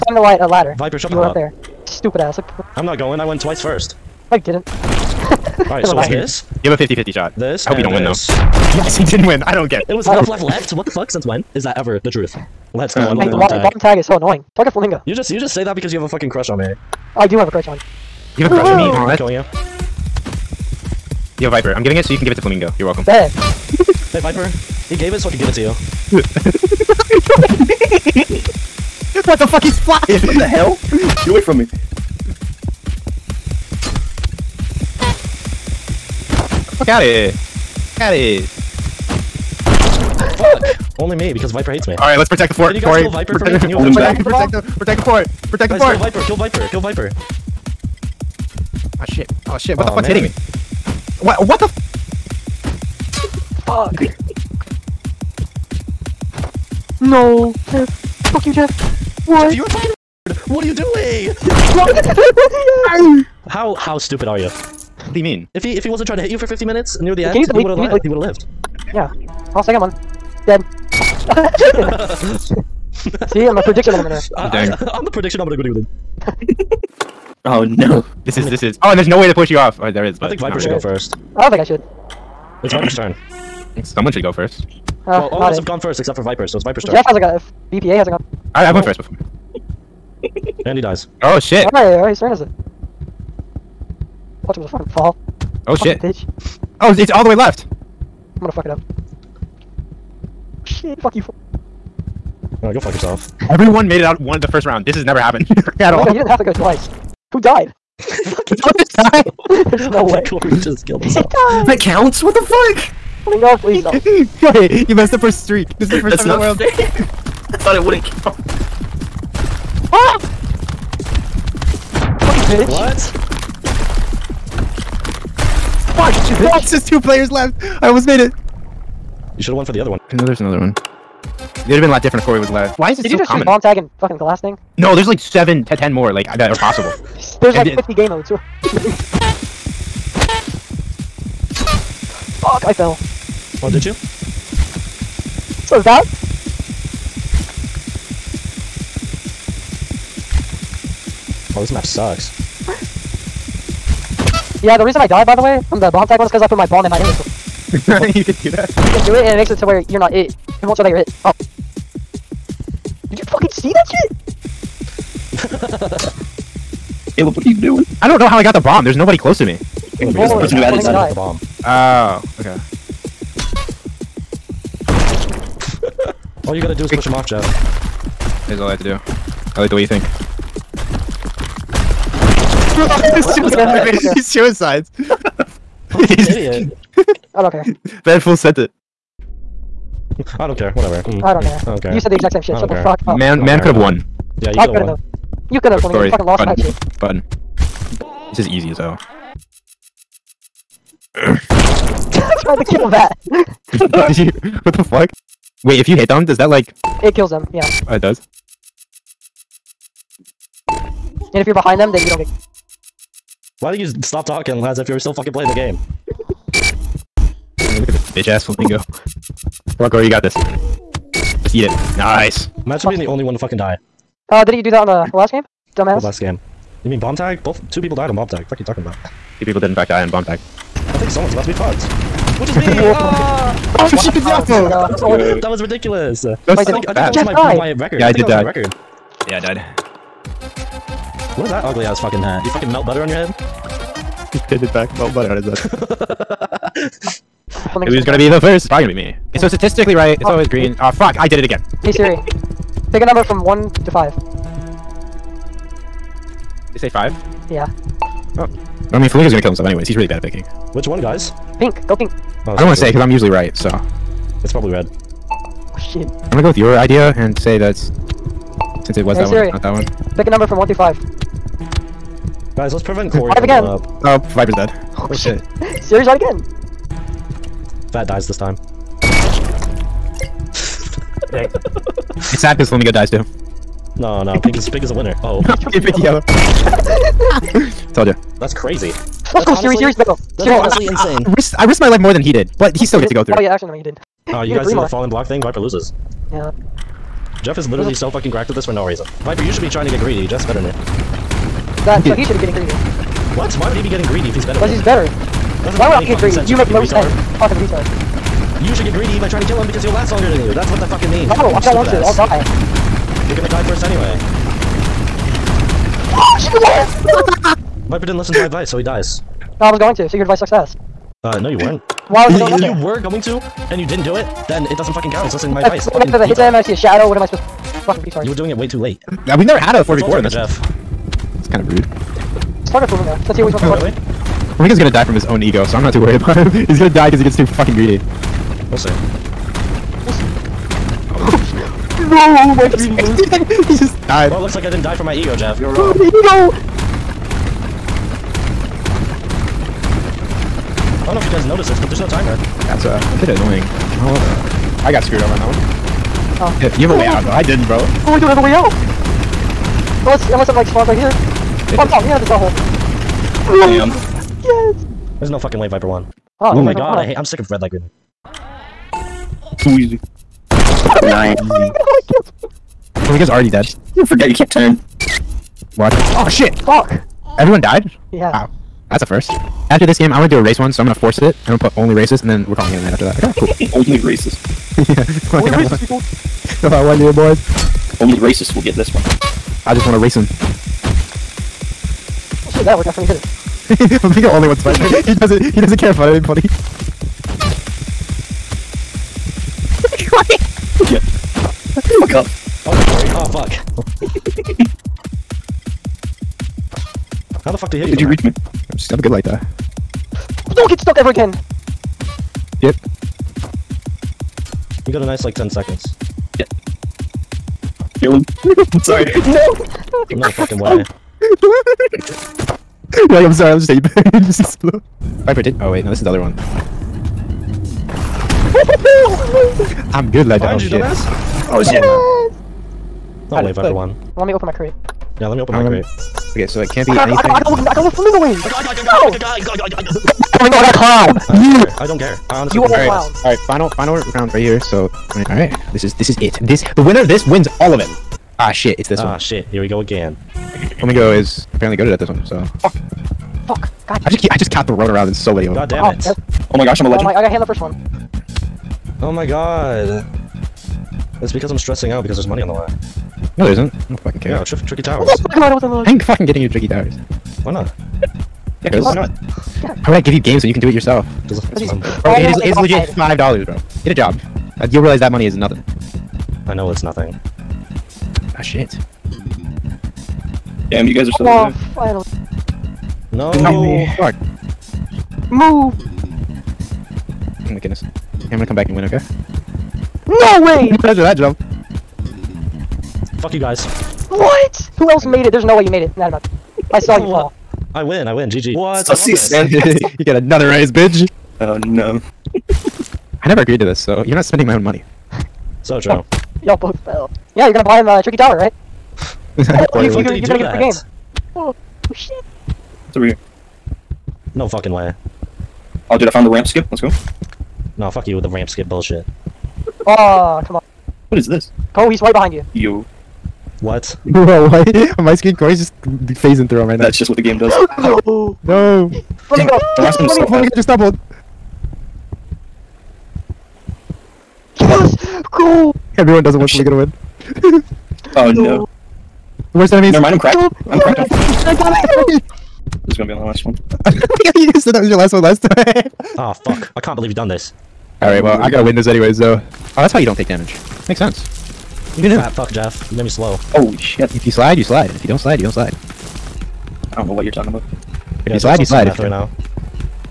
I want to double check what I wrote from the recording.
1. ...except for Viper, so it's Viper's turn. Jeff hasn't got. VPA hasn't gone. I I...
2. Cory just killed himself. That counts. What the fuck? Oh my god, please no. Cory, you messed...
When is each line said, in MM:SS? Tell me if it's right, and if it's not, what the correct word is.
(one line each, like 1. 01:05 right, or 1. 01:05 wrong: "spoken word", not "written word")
1. 01:25 right
2. 01:50 right.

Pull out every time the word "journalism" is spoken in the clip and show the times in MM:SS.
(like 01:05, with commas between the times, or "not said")
not said.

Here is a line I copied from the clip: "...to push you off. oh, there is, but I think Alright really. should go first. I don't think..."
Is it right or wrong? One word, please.
wrong.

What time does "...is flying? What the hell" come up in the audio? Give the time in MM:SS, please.
00:29.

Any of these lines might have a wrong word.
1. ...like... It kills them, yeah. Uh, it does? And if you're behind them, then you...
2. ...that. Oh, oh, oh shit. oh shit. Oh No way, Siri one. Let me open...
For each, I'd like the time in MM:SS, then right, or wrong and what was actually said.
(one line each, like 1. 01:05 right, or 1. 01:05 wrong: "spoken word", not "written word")
1. 03:26 right
2. 07:10 wrong: "Viper", not "Siri".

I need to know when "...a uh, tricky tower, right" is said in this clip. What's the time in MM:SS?
08:27.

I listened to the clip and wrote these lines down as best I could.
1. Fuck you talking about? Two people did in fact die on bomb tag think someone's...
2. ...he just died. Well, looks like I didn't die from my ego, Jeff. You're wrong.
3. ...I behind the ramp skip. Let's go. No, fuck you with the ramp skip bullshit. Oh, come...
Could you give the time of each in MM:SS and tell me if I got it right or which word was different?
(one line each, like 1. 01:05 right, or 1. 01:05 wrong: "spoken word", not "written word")
1. 03:48 right
2. 05:43 right
3. 08:36 wrong: "found", not "behind".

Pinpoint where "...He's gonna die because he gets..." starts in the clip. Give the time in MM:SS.
05:36.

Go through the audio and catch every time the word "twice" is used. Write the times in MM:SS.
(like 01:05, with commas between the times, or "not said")
00:03, 01:46.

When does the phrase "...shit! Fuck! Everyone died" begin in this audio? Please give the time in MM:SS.
06:16.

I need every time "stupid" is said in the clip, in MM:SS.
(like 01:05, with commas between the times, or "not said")
00:01, 01:03.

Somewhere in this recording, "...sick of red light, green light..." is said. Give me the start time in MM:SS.
06:07.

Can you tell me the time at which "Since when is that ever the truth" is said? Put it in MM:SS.
00:11.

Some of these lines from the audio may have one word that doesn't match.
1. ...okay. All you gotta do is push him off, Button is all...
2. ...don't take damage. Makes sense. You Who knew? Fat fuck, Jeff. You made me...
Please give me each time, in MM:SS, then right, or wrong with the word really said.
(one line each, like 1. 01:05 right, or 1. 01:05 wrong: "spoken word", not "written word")
1. 02:52 wrong: "Jeff", not "Button"
2. 09:10 right.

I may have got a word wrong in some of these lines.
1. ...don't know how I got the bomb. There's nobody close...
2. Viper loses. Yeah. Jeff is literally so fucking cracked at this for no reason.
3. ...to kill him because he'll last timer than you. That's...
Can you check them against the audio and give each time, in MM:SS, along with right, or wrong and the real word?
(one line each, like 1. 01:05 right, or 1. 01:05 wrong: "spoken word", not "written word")
1. 02:48 right
2. 04:55 right
3. 05:09 wrong: "longer", not "timer".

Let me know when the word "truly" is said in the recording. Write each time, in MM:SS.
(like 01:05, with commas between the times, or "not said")
not said.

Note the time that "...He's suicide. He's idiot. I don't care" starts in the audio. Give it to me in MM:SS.
03:04.